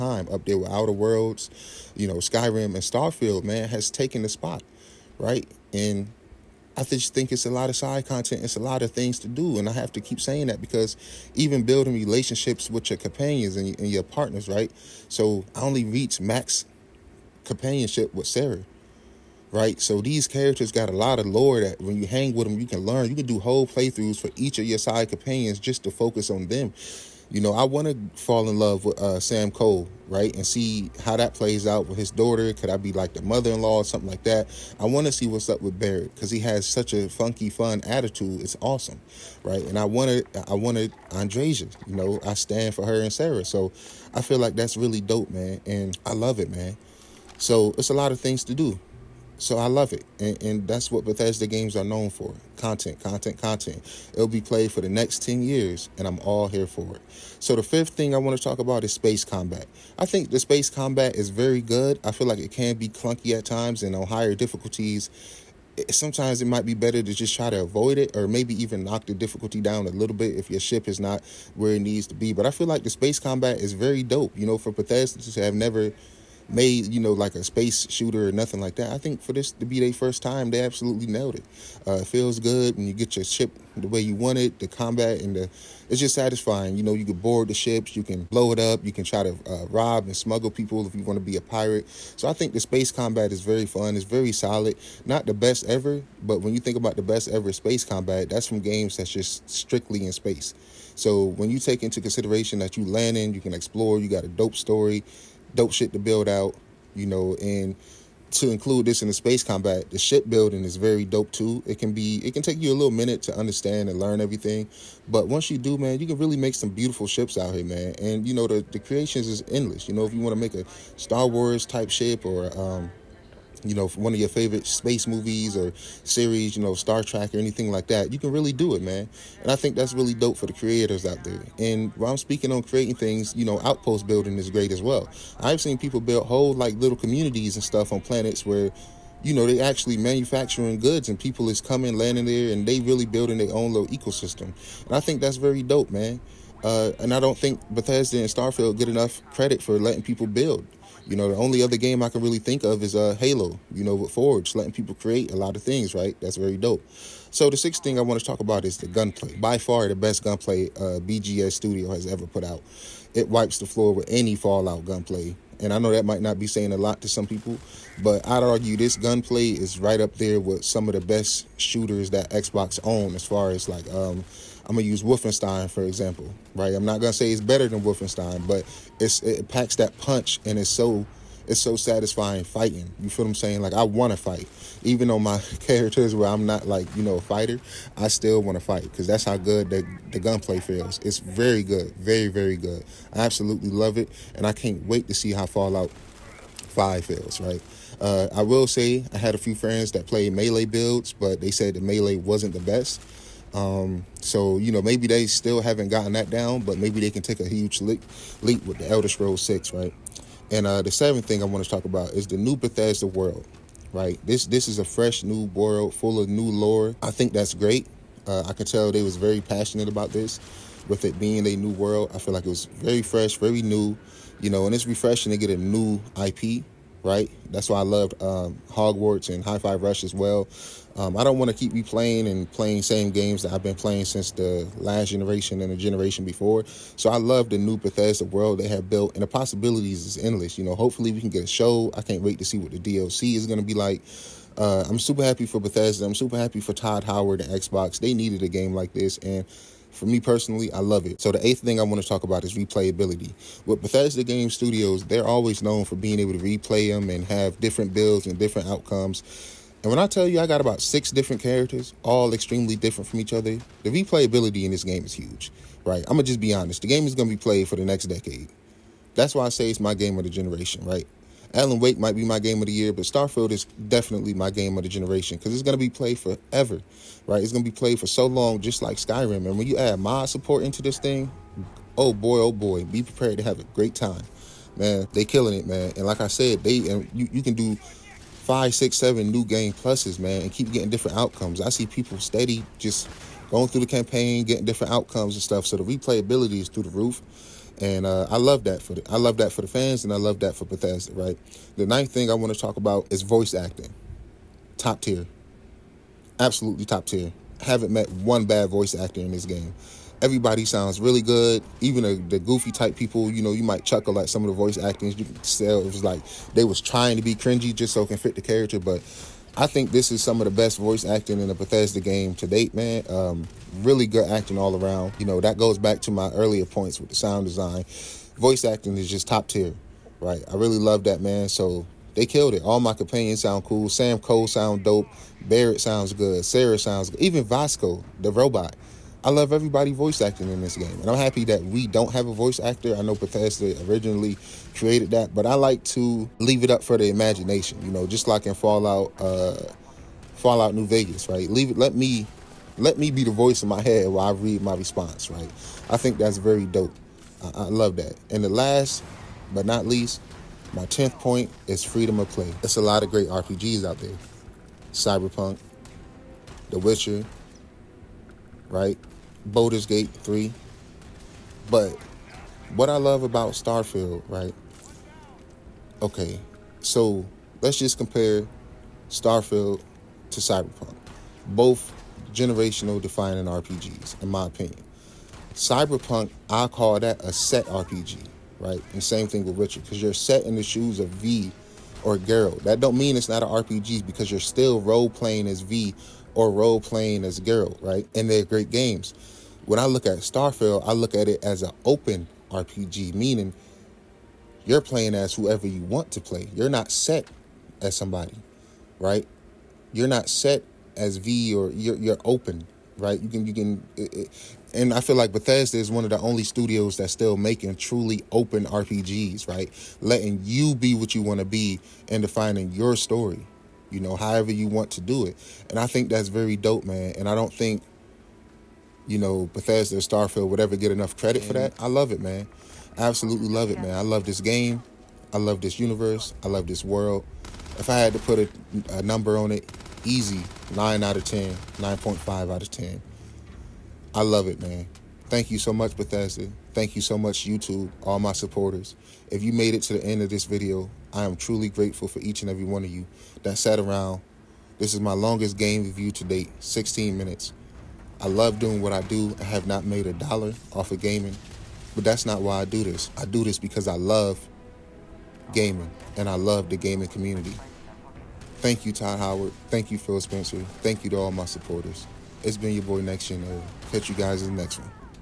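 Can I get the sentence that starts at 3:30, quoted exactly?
And uh, the seventh thing I want to talk about is the new Bethesda world, right?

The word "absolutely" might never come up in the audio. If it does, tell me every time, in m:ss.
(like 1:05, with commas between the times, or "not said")
1:20, 3:13, 5:06, 7:13.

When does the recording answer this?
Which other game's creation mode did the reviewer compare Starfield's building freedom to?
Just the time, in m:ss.
2:33.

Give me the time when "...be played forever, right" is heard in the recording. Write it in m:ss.
4:35.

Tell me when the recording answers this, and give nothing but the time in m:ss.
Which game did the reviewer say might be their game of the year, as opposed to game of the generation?
4:31.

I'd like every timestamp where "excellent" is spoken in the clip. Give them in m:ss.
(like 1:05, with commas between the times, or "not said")
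not said.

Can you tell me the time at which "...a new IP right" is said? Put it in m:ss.
3:45.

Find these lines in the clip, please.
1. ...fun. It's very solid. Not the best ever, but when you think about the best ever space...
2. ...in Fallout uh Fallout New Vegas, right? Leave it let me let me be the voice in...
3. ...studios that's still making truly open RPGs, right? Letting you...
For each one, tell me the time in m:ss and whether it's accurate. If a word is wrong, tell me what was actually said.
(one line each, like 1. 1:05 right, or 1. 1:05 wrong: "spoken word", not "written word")
1. 1:33 right
2. 5:48 right
3. 6:56 right.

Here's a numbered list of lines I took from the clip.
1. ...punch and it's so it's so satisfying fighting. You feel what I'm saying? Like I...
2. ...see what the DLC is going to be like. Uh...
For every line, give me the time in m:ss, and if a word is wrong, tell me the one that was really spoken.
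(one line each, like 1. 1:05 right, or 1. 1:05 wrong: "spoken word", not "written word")
1. 2:59 right
2. 4:02 right.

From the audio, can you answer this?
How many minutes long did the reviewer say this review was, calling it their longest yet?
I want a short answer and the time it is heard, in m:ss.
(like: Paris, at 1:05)
16, at 7:36.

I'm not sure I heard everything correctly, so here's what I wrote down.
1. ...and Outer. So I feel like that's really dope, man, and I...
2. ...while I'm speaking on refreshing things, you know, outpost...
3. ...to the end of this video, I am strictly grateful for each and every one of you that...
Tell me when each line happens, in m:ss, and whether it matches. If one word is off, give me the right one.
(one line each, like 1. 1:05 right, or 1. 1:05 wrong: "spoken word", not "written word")
1. 0:43 wrong: "Sarah", not "Outer"
2. 2:11 wrong: "creating", not "refreshing"
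3. 7:29 wrong: "truly", not "strictly".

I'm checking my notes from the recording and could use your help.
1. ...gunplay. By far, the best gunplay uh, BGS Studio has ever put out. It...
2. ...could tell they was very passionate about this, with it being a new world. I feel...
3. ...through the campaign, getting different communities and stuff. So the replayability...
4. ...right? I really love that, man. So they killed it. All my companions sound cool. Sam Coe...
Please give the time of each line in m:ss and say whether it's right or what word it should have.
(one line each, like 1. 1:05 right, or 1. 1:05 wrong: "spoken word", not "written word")
1. 2:38 right
2. 3:38 right
3. 4:53 wrong: "outcomes", not "communities"
4. 5:30 right.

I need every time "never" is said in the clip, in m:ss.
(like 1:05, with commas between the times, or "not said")
1:15.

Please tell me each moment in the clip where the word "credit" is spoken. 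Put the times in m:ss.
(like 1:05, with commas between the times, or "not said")
2:29, 7:11.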